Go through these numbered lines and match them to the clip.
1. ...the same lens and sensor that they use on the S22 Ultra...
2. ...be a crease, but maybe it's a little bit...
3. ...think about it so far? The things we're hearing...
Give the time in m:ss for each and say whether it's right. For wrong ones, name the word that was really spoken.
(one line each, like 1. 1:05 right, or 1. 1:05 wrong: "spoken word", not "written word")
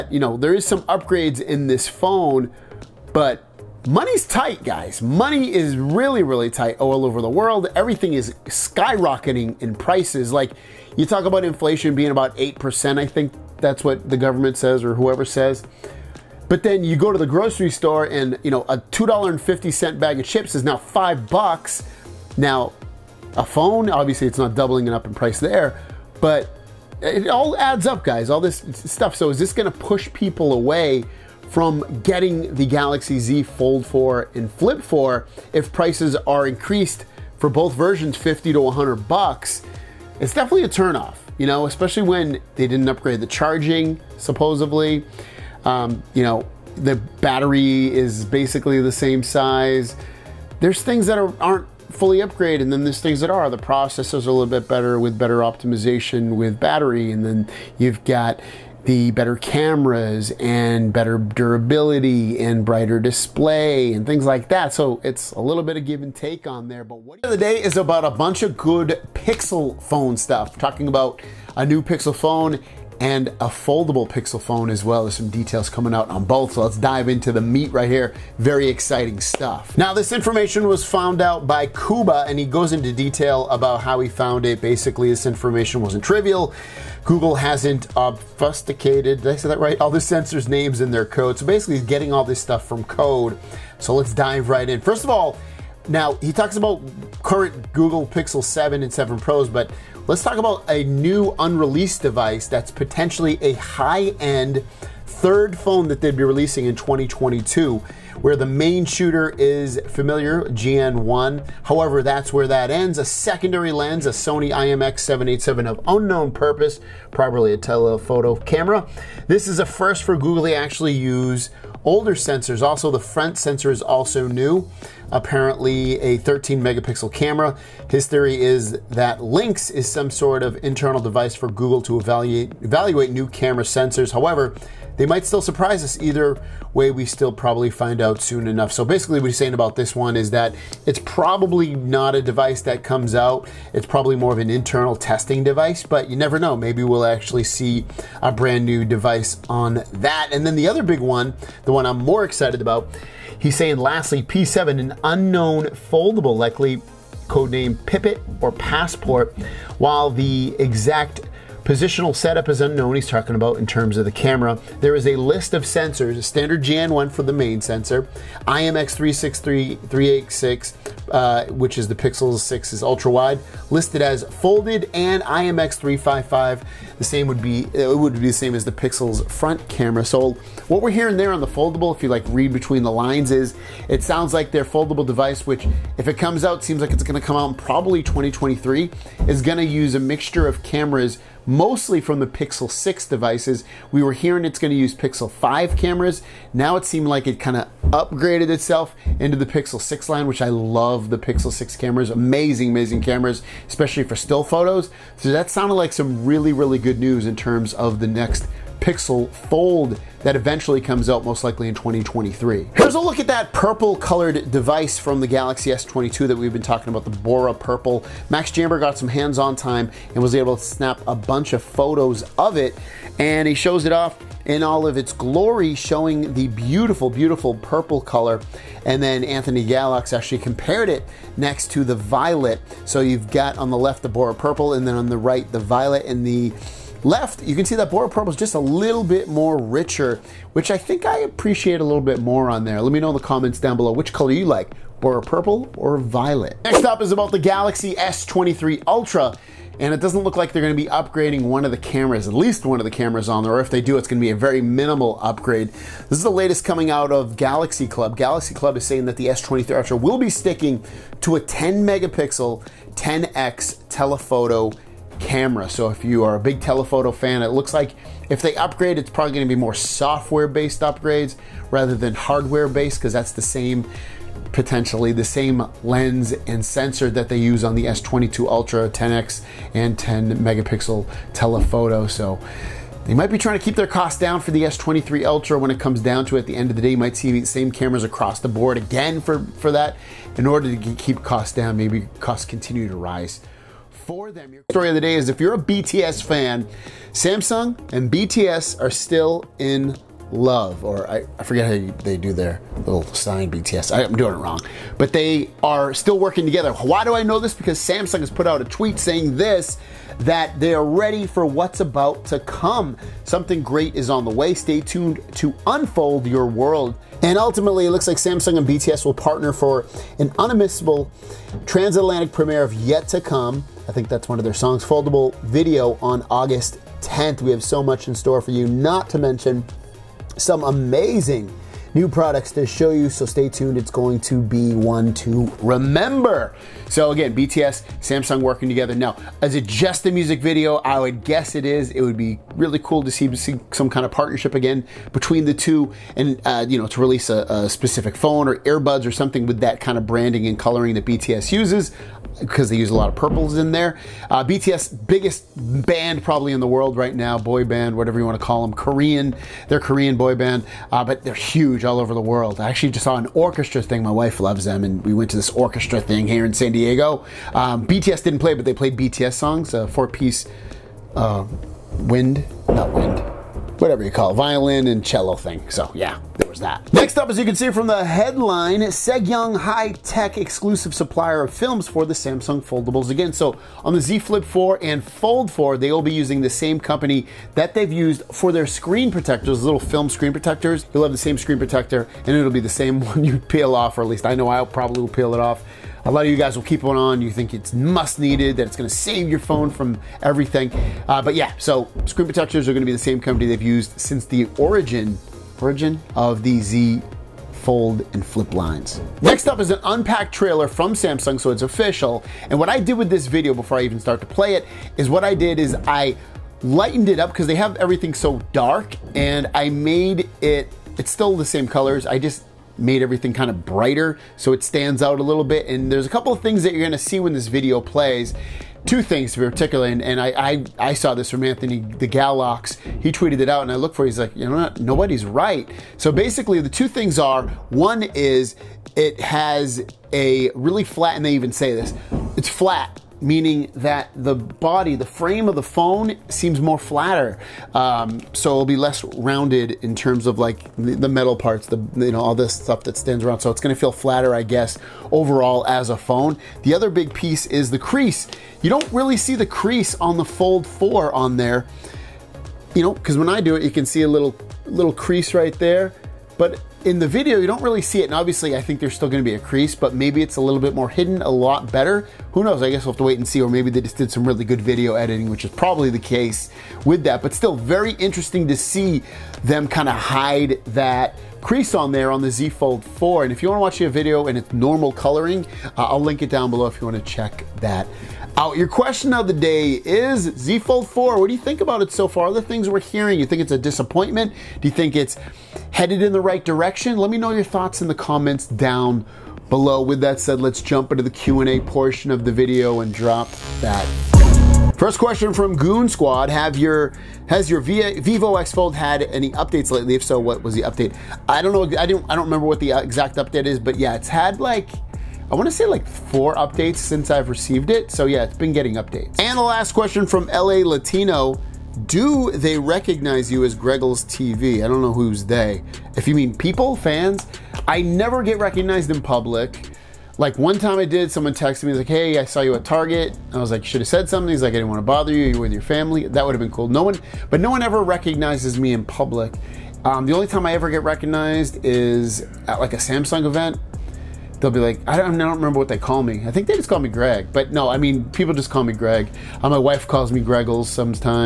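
1. 4:35 right
2. 7:49 right
3. 8:11 right.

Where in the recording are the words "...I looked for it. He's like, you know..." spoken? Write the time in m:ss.
7:13.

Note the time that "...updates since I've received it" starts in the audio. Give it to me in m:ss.
8:36.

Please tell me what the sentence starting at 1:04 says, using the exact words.
So it's a little bit of give and take on there.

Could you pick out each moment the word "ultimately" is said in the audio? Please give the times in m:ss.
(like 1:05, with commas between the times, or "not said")
5:17.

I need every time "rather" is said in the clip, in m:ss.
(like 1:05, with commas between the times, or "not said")
4:31.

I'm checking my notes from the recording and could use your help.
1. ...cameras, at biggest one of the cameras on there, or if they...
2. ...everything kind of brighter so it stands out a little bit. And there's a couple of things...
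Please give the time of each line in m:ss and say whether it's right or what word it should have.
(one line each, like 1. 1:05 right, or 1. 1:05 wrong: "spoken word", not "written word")
1. 4:11 wrong: "least", not "biggest"
2. 7:03 right.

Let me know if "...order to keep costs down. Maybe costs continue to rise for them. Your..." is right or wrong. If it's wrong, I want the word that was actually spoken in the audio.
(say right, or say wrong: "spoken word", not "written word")
right.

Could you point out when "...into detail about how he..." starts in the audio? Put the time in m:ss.
1:22.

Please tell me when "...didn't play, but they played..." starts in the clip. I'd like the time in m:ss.
6:08.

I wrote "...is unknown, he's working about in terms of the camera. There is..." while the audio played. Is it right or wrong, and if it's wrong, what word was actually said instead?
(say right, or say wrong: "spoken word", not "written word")
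wrong: "talking", not "working".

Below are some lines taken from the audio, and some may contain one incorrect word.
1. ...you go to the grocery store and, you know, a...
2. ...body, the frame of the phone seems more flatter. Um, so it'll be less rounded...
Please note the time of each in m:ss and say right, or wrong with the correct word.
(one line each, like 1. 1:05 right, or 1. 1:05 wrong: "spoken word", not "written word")
1. 0:16 right
2. 7:24 right.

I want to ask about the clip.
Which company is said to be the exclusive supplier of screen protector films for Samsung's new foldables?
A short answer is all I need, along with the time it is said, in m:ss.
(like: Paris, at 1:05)
Segyang High Tech, at 6:18.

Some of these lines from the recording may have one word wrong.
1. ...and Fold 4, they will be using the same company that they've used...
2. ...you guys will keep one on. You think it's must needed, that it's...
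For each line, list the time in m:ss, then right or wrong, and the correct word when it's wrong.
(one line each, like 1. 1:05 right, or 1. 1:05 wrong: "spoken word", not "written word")
1. 6:24 right
2. 6:36 right.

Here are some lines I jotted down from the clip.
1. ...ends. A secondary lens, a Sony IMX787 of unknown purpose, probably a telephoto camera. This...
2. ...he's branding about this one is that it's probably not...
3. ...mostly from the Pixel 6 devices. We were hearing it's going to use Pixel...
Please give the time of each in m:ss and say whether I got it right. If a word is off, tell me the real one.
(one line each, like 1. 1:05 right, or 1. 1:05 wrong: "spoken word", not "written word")
1. 1:52 right
2. 2:19 wrong: "saying", not "branding"
3. 3:11 right.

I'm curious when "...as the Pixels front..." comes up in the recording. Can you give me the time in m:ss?
2:58.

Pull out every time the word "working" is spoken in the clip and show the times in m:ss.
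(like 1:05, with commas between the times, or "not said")
5:06, 5:38.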